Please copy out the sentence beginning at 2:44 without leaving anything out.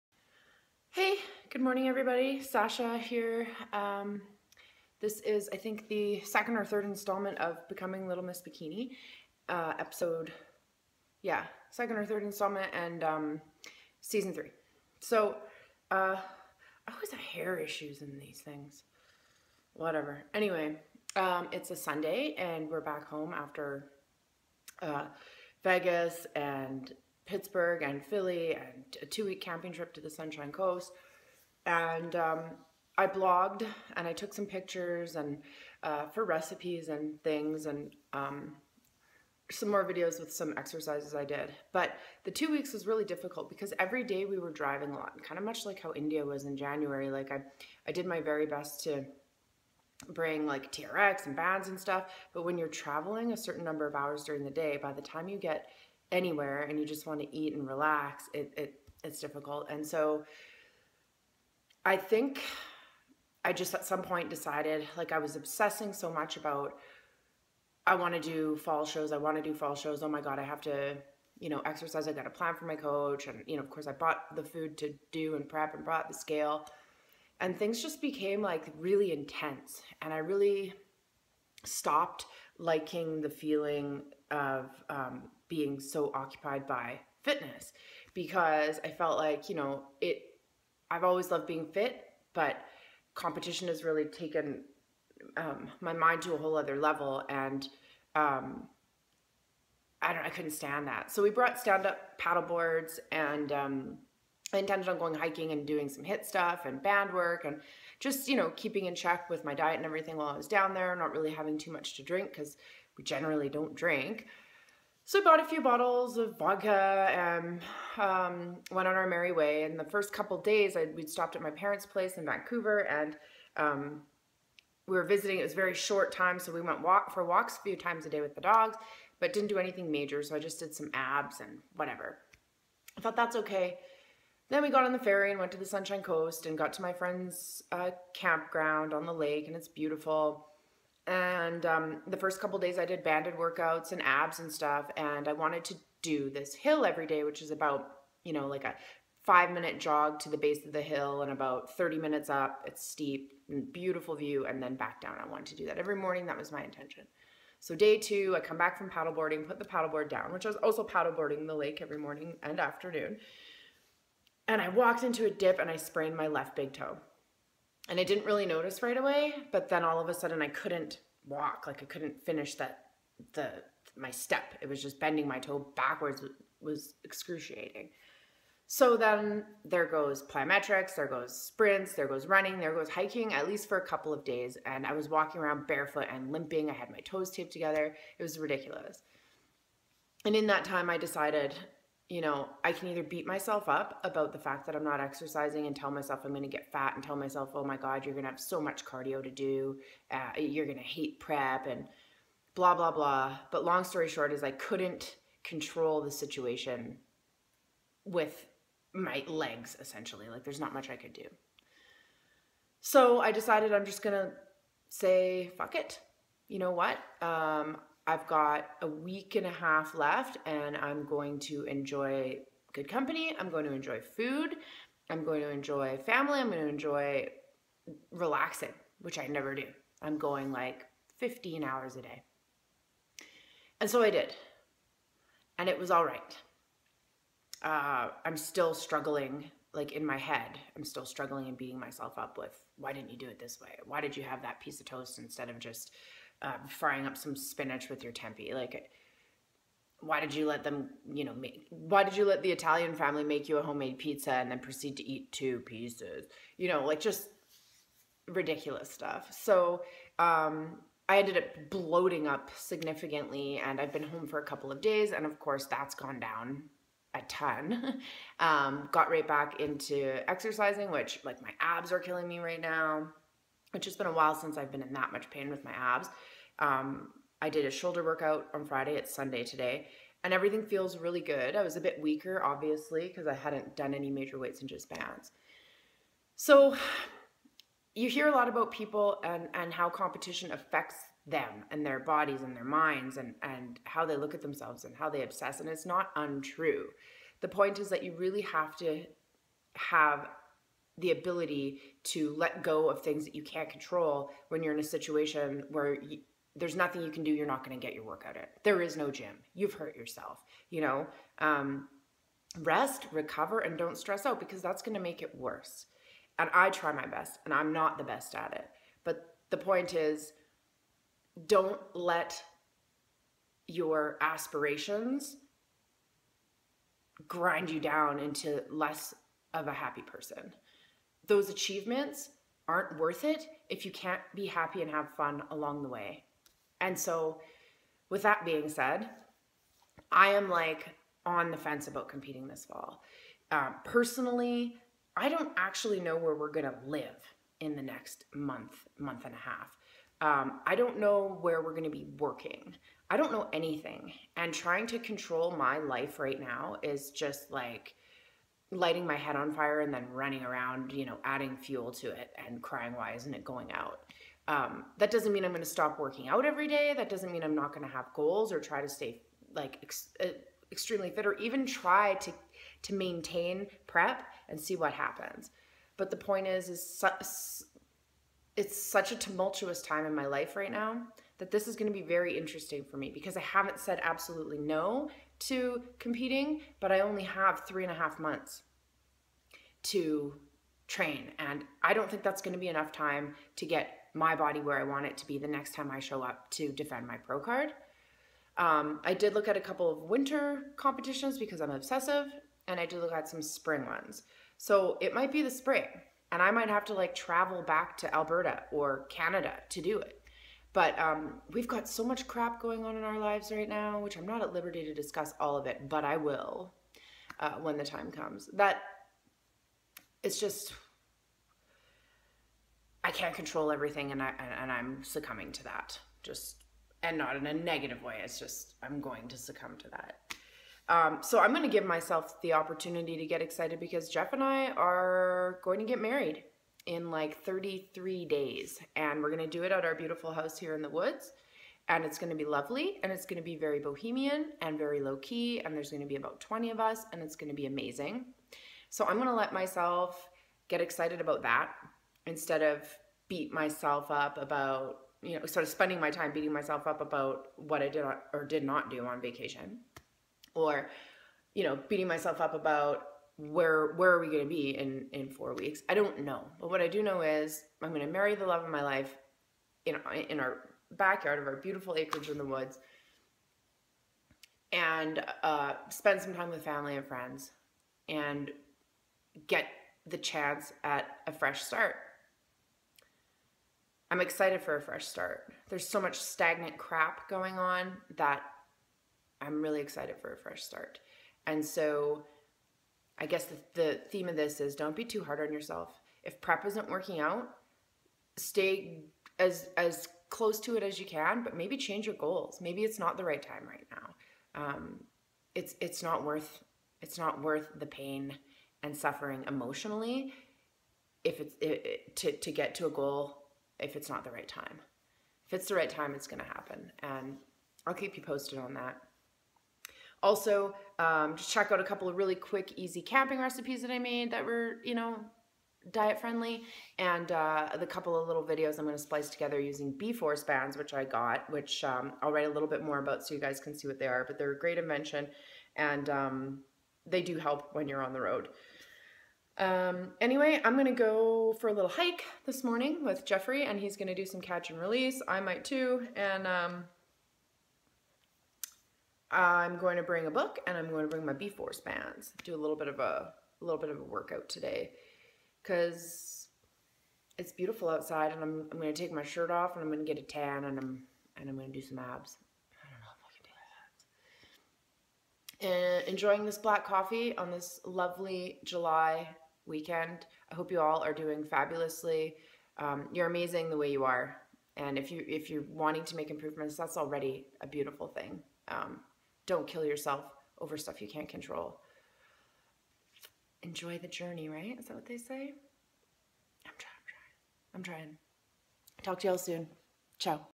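And I walked into a dip and I sprained my left big toe.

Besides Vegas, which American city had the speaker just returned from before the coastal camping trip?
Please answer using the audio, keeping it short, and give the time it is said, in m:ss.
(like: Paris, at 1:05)
Pittsburgh, at 0:27.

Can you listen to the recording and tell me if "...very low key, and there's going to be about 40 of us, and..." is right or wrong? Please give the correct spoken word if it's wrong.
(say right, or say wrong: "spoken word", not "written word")
wrong: "20", not "40".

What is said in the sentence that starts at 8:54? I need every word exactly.
But they're a great invention, and um, they do help when you're on the road.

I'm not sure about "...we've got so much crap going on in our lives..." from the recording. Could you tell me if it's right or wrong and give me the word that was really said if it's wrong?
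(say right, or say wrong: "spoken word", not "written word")
right.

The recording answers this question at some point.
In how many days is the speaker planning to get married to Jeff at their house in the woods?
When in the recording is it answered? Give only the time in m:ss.
7:17.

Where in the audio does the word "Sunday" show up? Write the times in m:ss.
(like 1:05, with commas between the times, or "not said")
0:21, 4:39.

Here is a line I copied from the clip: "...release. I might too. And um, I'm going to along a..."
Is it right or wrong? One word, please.
wrong.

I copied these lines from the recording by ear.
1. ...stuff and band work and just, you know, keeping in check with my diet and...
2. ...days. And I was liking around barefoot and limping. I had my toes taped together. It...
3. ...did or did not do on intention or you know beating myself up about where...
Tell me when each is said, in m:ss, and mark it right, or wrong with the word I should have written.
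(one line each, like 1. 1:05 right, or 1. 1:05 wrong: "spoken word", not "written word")
1. 1:46 right
2. 3:04 wrong: "walking", not "liking"
3. 7:37 wrong: "vacation", not "intention".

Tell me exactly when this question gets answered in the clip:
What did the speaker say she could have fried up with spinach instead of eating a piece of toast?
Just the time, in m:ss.
4:08.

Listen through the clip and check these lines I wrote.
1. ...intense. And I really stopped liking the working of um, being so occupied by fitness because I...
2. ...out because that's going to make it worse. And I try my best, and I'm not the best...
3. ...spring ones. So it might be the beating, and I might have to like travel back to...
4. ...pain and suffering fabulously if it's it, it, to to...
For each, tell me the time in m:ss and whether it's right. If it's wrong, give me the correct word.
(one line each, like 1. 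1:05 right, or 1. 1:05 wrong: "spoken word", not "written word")
1. 1:19 wrong: "feeling", not "working"
2. 5:14 right
3. 6:43 wrong: "spring", not "beating"
4. 8:27 wrong: "emotionally", not "fabulously".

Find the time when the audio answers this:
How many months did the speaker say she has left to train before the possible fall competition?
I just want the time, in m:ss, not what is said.
6:27.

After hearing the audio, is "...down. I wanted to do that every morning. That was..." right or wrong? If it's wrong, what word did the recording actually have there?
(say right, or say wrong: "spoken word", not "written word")
right.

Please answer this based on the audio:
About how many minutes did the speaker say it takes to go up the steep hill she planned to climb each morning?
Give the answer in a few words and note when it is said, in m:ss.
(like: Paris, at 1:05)
30, at 2:31.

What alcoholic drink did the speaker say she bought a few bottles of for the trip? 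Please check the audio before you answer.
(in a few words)
vodka.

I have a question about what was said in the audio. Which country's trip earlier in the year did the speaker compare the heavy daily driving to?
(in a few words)
India.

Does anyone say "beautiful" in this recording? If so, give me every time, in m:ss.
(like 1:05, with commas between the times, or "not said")
2:19, 2:33, 7:19, 7:51, 9:17, 9:37.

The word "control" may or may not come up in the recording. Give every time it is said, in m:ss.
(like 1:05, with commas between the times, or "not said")
3:25, 5:03, 5:54, 7:03, 9:41.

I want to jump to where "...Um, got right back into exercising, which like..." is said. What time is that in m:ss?
4:28.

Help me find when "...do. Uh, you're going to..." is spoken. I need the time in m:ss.
3:19.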